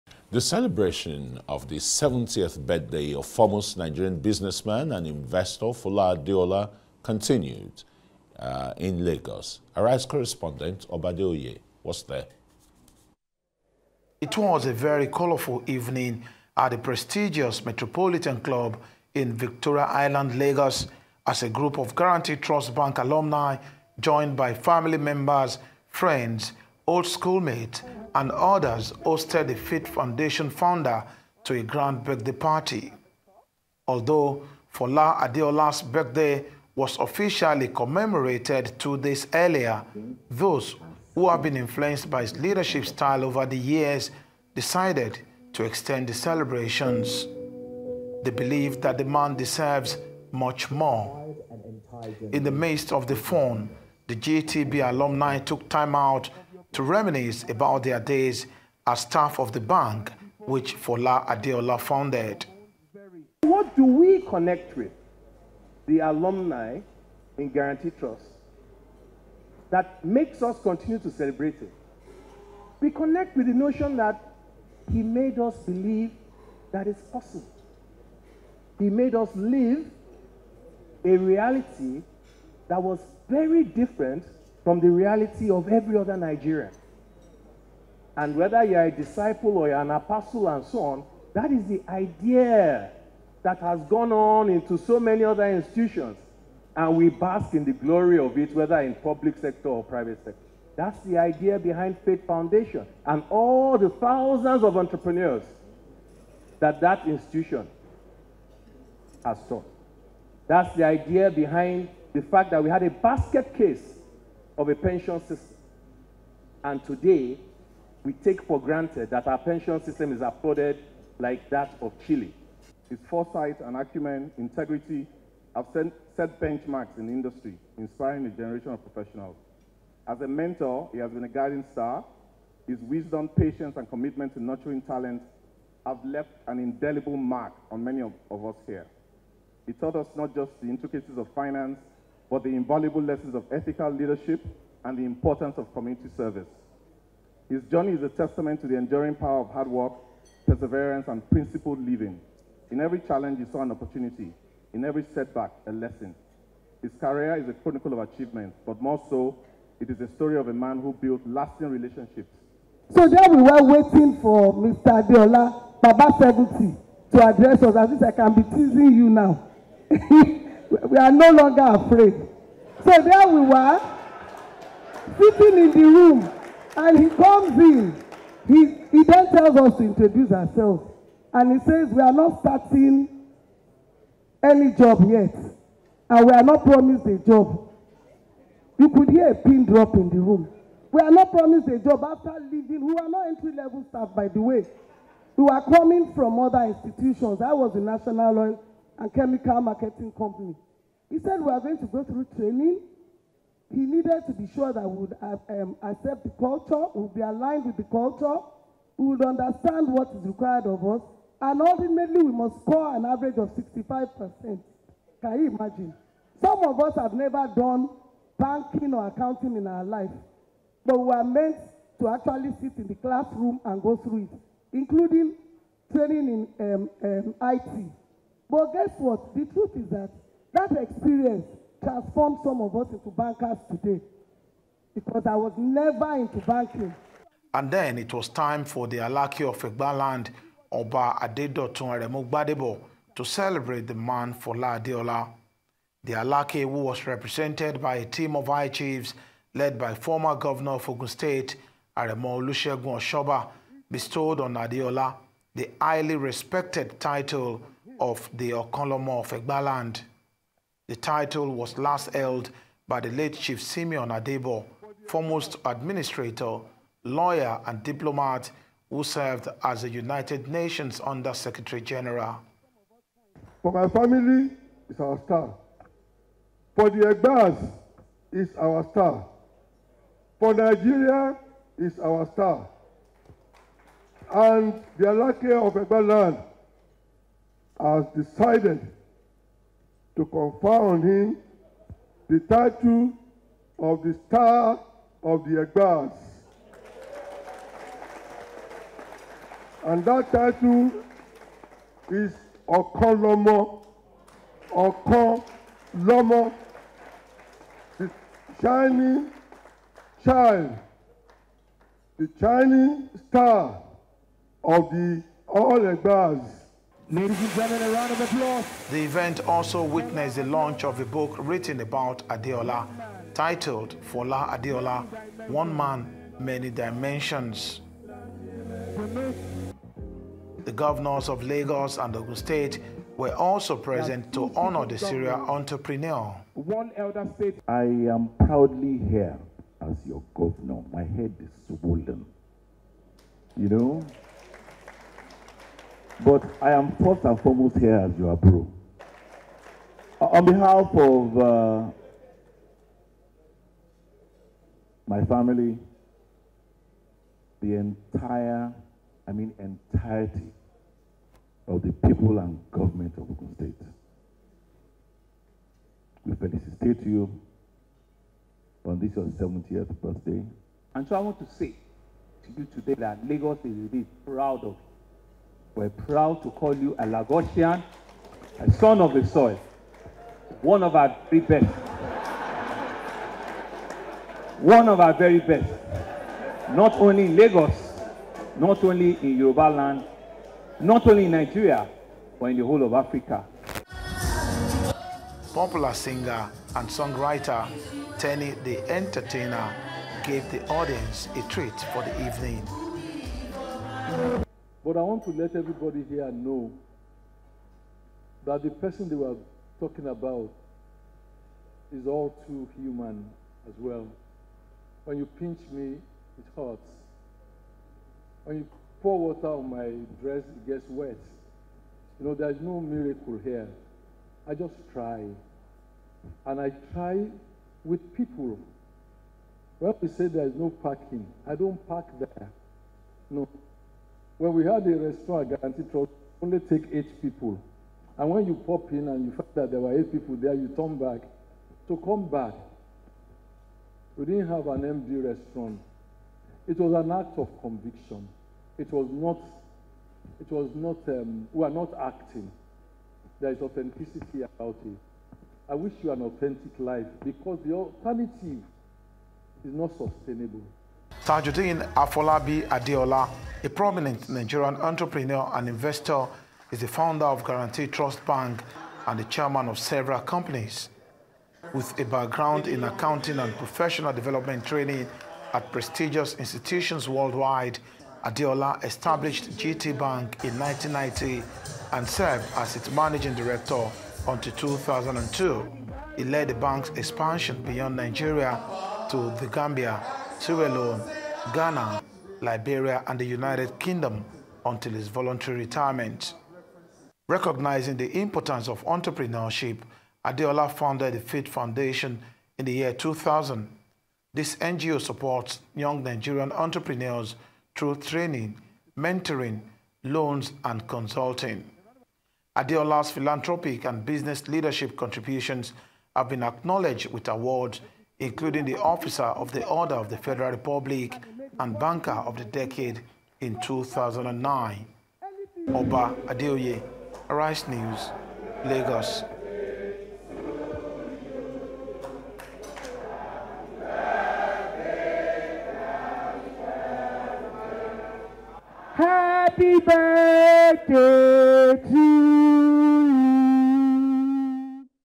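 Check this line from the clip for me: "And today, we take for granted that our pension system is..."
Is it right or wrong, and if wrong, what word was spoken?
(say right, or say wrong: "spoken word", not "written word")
right.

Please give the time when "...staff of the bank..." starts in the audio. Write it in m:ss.
0:59.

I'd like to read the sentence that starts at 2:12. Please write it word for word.
His wisdom, patience, and commitment to nurturing talent have left an indelible mark on many of, of us here.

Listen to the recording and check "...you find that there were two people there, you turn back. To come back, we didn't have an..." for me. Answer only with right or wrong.
wrong.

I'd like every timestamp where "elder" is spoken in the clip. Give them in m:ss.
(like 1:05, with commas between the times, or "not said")
5:36.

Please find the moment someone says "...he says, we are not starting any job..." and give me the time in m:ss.
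3:01.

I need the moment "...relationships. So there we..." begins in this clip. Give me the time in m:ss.
2:41.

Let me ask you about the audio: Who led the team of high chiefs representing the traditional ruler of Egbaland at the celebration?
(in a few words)
Aremo Olusegun Oshoba.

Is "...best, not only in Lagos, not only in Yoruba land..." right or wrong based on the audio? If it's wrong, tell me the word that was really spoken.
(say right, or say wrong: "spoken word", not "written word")
right.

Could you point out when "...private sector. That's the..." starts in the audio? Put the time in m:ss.
1:39.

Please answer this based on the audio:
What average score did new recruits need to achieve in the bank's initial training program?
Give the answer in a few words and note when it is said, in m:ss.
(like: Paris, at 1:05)
65%, at 3:33.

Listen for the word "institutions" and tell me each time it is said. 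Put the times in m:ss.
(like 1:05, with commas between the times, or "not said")
1:35, 1:47, 3:16, 7:56.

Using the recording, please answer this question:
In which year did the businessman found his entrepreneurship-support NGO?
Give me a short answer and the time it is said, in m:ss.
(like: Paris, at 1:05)
2000, at 8:22.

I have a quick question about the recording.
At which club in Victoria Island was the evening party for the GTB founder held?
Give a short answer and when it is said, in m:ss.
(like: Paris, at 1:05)
Metropolitan Club, at 0:17.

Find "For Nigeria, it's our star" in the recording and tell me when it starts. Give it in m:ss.
4:40.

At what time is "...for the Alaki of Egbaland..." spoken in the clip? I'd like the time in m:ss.
3:58.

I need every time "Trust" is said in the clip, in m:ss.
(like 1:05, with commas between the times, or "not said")
0:22, 1:07, 7:15, 7:47.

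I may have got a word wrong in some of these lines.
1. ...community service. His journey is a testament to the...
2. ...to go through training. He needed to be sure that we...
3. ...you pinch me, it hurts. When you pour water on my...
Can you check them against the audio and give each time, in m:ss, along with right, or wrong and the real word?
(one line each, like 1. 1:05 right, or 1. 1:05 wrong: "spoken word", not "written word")
1. 2:25 right
2. 3:21 right
3. 6:55 right.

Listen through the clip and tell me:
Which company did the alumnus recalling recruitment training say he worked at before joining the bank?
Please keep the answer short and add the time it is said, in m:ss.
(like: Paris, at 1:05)
National Oil and Chemical Marketing Company, at 3:17.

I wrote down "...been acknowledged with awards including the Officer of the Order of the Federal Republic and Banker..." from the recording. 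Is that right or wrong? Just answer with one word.
right.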